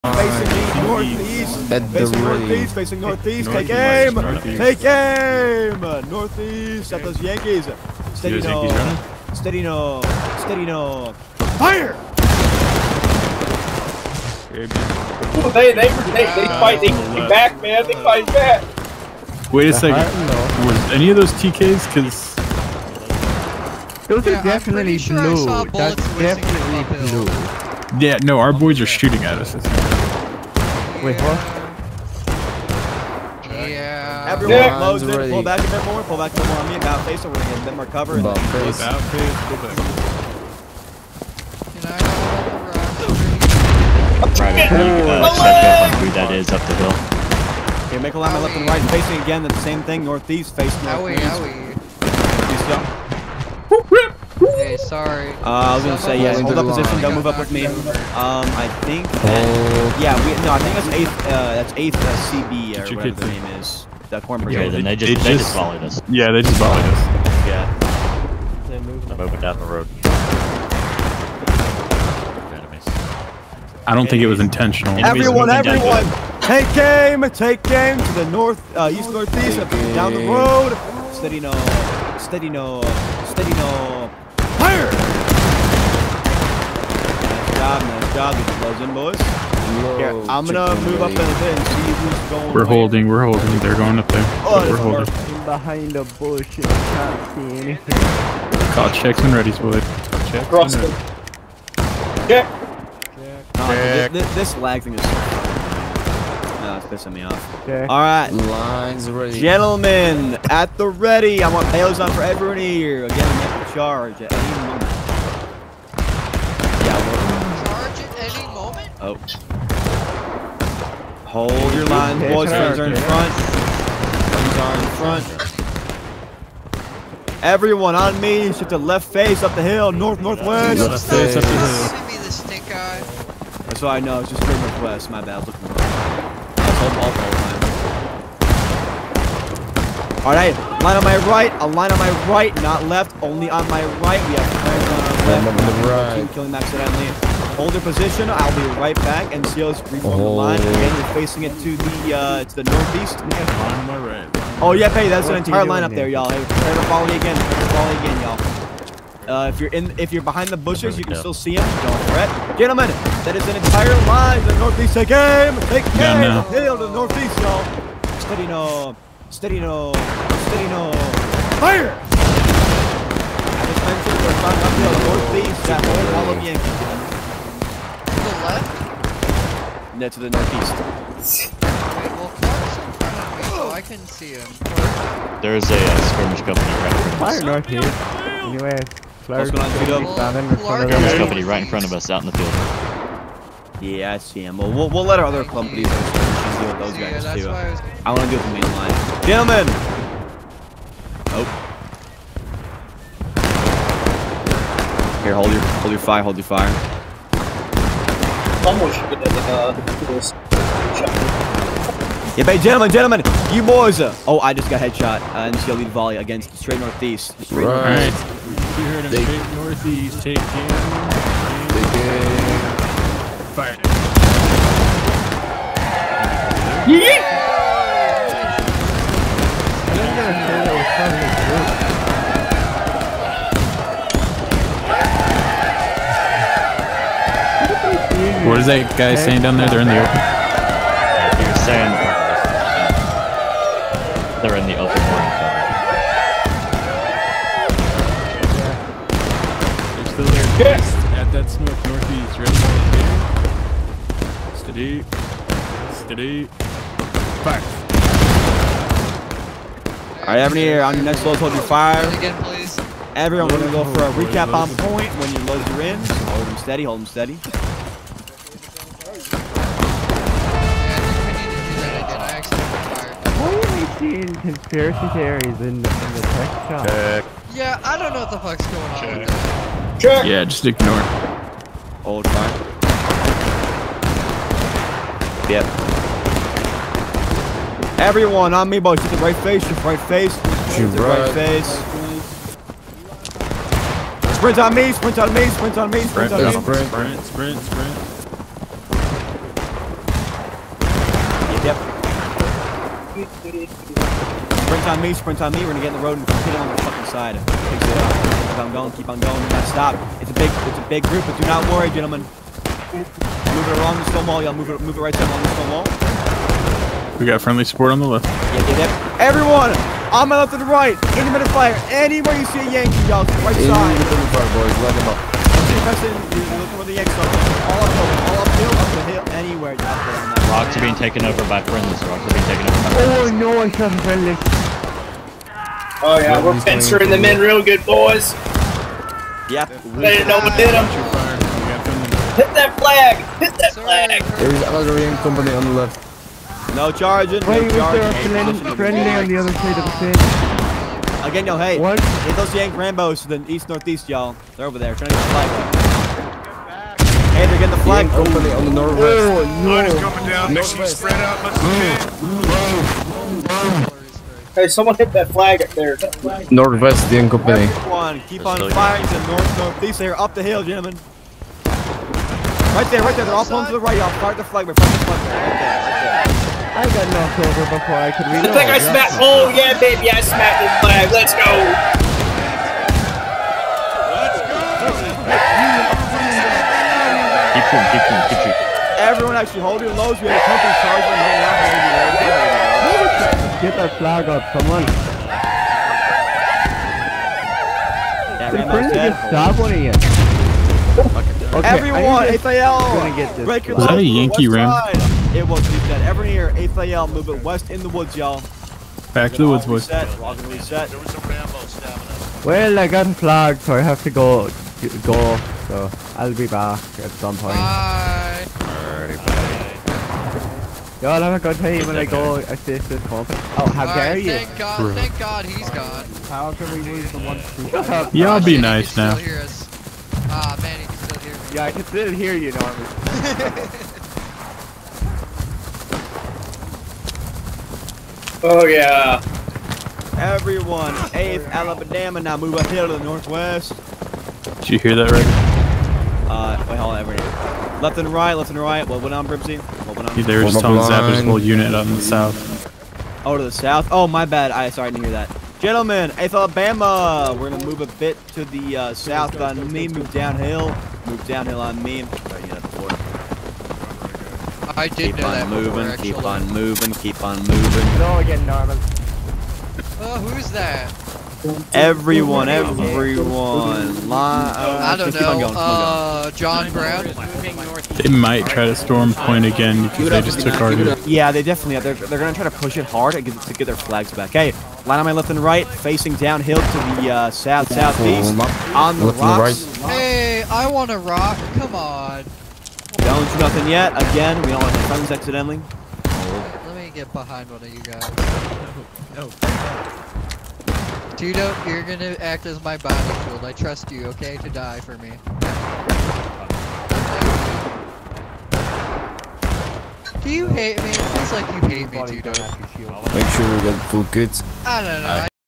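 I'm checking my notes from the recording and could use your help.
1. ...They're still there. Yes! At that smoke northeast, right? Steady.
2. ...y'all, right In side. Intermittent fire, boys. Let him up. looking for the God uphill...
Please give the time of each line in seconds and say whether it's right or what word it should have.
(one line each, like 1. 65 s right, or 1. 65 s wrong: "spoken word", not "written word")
1. 249 s right
2. 323 s wrong: "All", not "God".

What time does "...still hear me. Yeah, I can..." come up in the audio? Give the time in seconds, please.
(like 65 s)
430 s.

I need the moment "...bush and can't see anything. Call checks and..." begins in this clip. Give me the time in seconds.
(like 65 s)
96 s.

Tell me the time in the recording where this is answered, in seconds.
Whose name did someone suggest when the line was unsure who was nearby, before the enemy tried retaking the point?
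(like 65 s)
476 s.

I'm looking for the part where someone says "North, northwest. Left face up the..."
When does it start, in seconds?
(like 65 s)
129 s.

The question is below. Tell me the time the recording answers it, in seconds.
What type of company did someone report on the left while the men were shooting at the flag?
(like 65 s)
344 s.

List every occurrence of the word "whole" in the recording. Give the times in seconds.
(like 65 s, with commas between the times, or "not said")
175 s, 451 s.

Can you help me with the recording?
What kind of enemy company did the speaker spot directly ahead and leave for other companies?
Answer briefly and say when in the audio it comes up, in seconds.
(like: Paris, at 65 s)
skirmish company, at 186 s.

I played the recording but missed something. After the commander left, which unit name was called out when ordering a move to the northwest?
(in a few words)
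8th Alabama.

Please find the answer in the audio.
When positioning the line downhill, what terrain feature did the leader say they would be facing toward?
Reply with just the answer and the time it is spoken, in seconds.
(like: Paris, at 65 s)
the rocks, at 488 s.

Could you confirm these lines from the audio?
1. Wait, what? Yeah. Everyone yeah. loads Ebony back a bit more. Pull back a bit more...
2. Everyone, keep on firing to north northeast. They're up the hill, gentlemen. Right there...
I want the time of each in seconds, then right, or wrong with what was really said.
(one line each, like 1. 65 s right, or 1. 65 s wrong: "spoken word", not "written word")
1. 31 s wrong: "Pull", not "Ebony"
2. 367 s right.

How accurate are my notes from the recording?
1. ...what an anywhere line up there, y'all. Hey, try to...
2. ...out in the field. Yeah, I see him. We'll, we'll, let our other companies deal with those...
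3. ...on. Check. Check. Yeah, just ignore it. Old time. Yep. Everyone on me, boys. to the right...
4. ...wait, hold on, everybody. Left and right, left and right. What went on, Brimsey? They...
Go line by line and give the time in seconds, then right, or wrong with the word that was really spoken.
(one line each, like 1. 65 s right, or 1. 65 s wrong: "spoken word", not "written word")
1. 155 s wrong: "entire", not "anywhere"
2. 192 s right
3. 278 s right
4. 446 s right.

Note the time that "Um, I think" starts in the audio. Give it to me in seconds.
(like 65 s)
57 s.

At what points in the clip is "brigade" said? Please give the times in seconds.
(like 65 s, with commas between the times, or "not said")
64 s.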